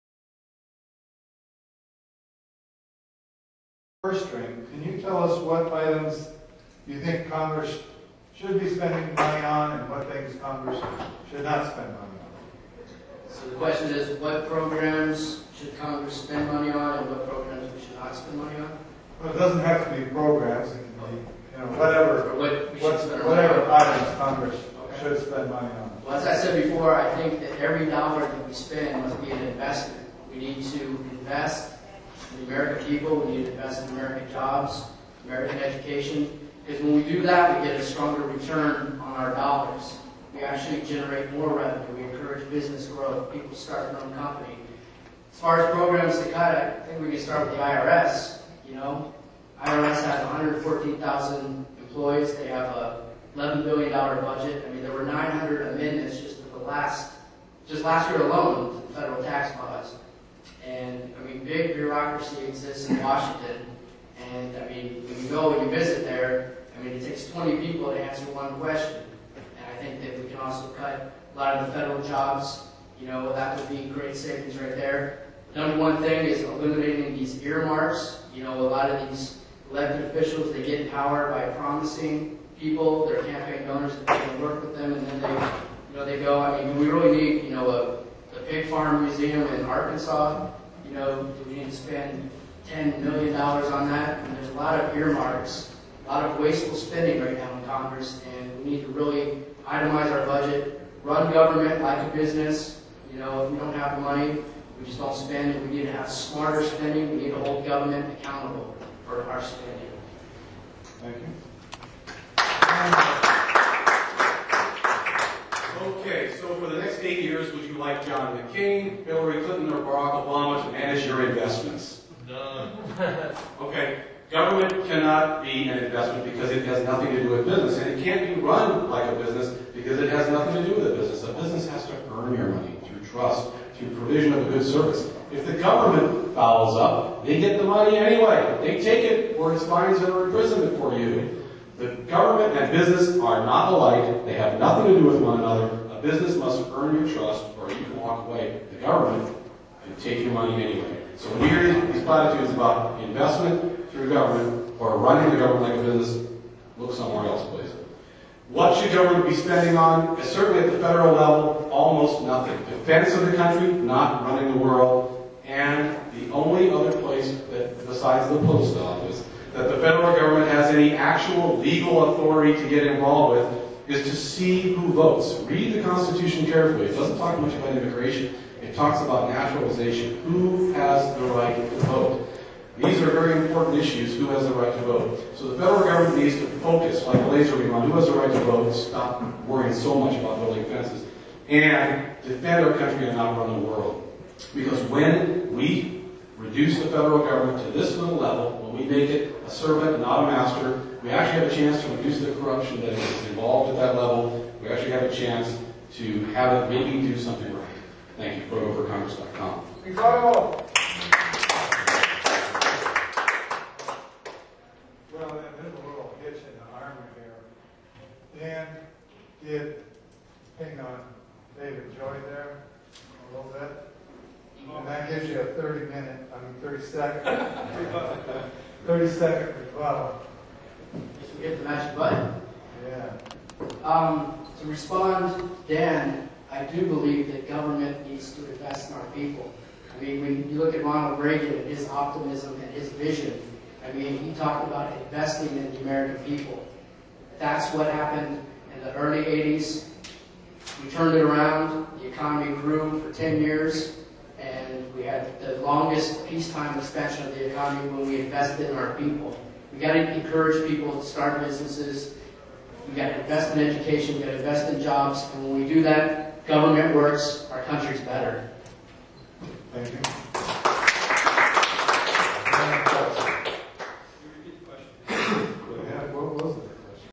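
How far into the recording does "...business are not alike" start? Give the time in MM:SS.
02:22.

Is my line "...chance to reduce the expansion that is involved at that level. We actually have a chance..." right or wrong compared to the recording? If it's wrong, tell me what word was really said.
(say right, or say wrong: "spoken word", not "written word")
wrong: "corruption", not "expansion".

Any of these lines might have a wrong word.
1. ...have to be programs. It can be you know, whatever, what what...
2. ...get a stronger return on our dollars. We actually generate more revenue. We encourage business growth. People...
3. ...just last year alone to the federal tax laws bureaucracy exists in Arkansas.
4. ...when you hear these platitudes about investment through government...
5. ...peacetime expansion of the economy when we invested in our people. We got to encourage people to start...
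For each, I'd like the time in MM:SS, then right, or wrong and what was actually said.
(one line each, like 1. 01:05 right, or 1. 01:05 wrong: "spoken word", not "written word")
1. 00:19 right
2. 00:37 right
3. 00:57 wrong: "Washington", not "Arkansas"
4. 02:31 right
5. 04:16 right.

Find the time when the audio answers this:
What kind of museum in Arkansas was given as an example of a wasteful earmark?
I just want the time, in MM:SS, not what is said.
01:28.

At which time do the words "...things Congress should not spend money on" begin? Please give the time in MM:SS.
00:10.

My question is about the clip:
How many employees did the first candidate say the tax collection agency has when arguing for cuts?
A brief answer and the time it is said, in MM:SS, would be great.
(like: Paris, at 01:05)
114,000, at 00:50.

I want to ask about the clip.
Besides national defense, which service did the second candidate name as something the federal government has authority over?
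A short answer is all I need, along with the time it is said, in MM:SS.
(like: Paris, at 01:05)
post office, at 02:48.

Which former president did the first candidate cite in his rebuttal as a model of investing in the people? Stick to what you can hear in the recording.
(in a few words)
Ronald Reagan.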